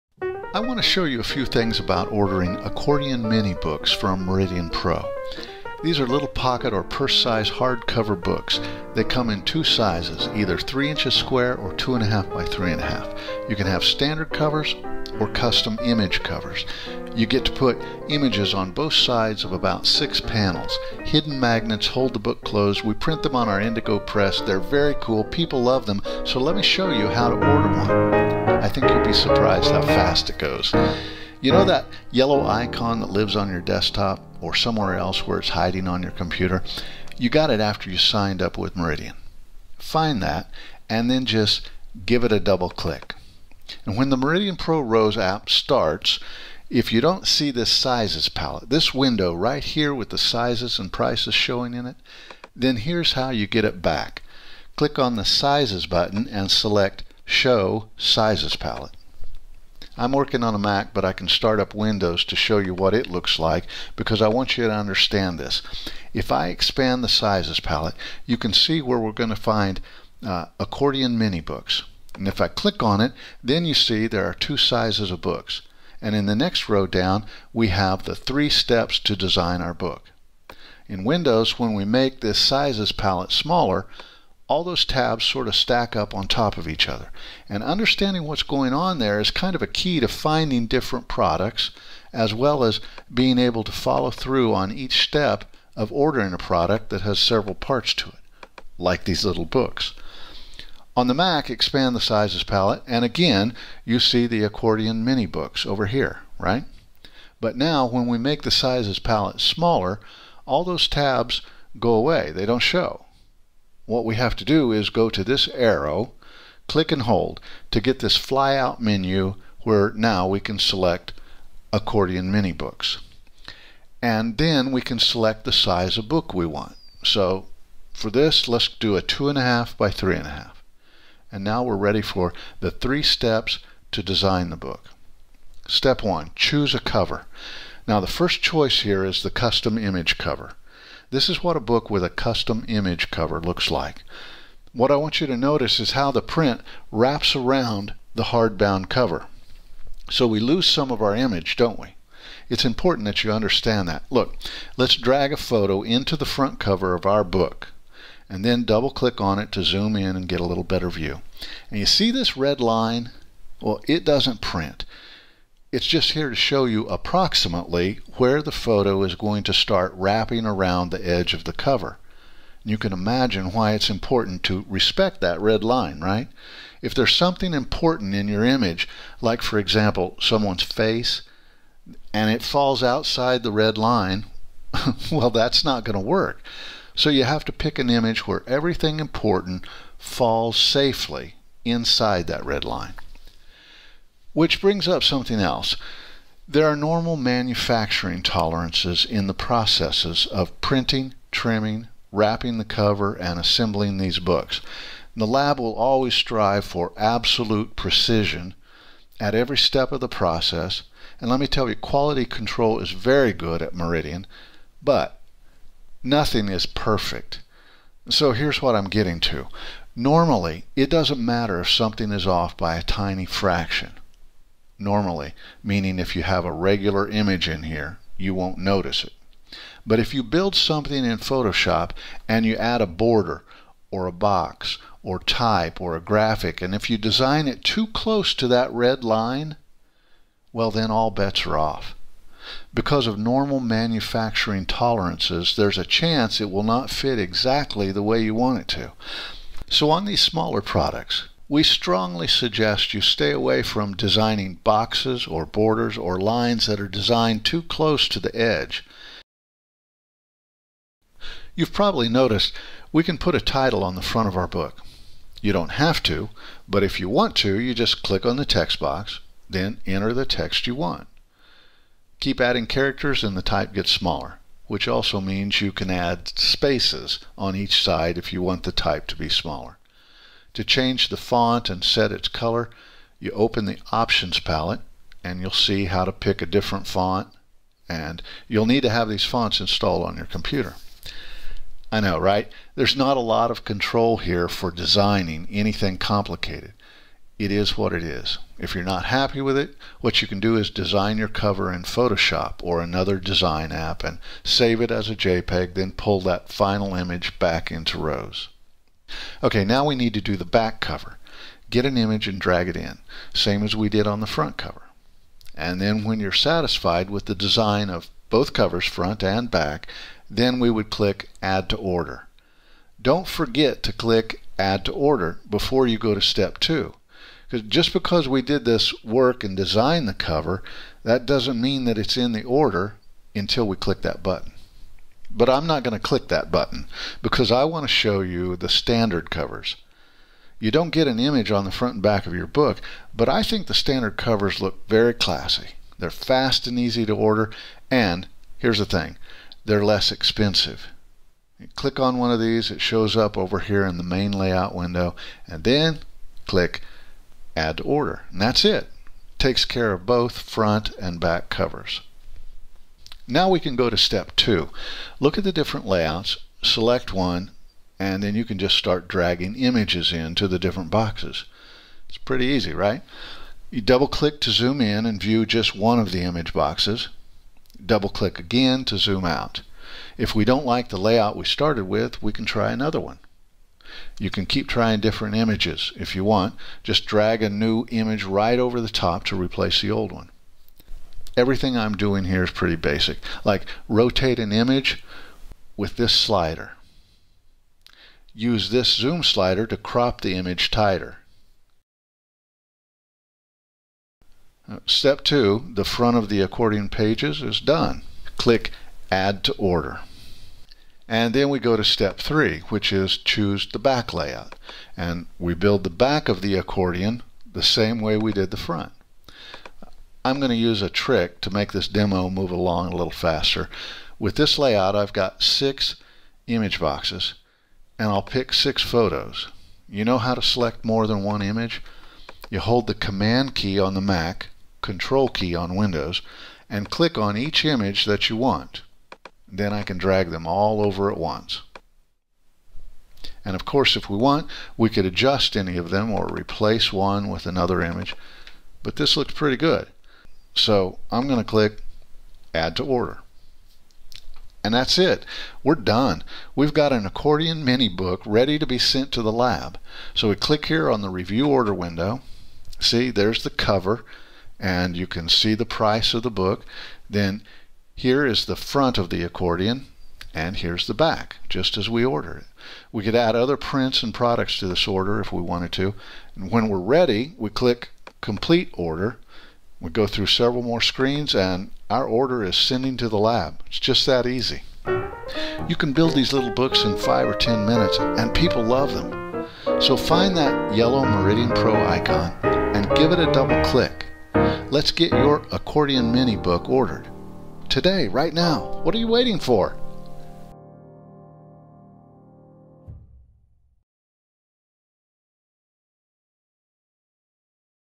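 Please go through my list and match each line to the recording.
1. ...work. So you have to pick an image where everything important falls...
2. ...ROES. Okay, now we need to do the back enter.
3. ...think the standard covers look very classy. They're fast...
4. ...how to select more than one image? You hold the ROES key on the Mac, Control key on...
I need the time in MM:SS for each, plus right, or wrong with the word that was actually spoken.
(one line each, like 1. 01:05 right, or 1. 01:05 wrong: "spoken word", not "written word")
1. 03:06 right
2. 05:07 wrong: "cover", not "enter"
3. 05:43 right
4. 07:10 wrong: "Command", not "ROES".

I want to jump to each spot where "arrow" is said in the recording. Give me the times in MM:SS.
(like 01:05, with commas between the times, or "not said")
01:55.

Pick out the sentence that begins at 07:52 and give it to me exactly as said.
We could add other prints and products to this order if we wanted to.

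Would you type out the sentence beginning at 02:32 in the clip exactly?
It's important that you understand that.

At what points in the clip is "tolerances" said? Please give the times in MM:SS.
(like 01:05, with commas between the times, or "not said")
03:18, 04:04.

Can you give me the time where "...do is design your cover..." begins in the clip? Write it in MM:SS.
05:00.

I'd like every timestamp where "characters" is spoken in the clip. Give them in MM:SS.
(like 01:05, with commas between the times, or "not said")
04:32.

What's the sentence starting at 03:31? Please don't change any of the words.
And let me tell you, quality control is very good at Meridian, but nothing is perfect.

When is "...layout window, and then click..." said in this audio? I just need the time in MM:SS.
05:54.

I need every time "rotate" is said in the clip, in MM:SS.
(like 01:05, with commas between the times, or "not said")
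06:33.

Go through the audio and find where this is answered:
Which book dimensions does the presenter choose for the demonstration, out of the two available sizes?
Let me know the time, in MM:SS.
02:09.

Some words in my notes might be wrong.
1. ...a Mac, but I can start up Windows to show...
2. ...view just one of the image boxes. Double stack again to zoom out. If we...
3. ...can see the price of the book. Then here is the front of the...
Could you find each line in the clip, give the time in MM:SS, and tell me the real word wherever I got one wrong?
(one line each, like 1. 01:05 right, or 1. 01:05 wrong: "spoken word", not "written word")
1. 01:00 right
2. 06:15 wrong: "click", not "stack"
3. 07:45 right.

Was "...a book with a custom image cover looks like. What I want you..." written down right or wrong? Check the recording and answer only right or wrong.
right.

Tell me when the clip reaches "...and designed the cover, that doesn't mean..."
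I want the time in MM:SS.
05:29.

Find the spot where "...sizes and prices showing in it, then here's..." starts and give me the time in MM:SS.
00:50.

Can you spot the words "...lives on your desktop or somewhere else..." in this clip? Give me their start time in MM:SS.
00:33.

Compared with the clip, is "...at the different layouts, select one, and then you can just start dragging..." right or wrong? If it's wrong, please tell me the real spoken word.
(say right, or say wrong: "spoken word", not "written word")
right.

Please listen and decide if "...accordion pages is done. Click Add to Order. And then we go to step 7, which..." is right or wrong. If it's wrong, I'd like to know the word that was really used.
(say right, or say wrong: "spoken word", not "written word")
wrong: "3", not "7".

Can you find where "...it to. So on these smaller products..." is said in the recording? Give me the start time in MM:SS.
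04:08.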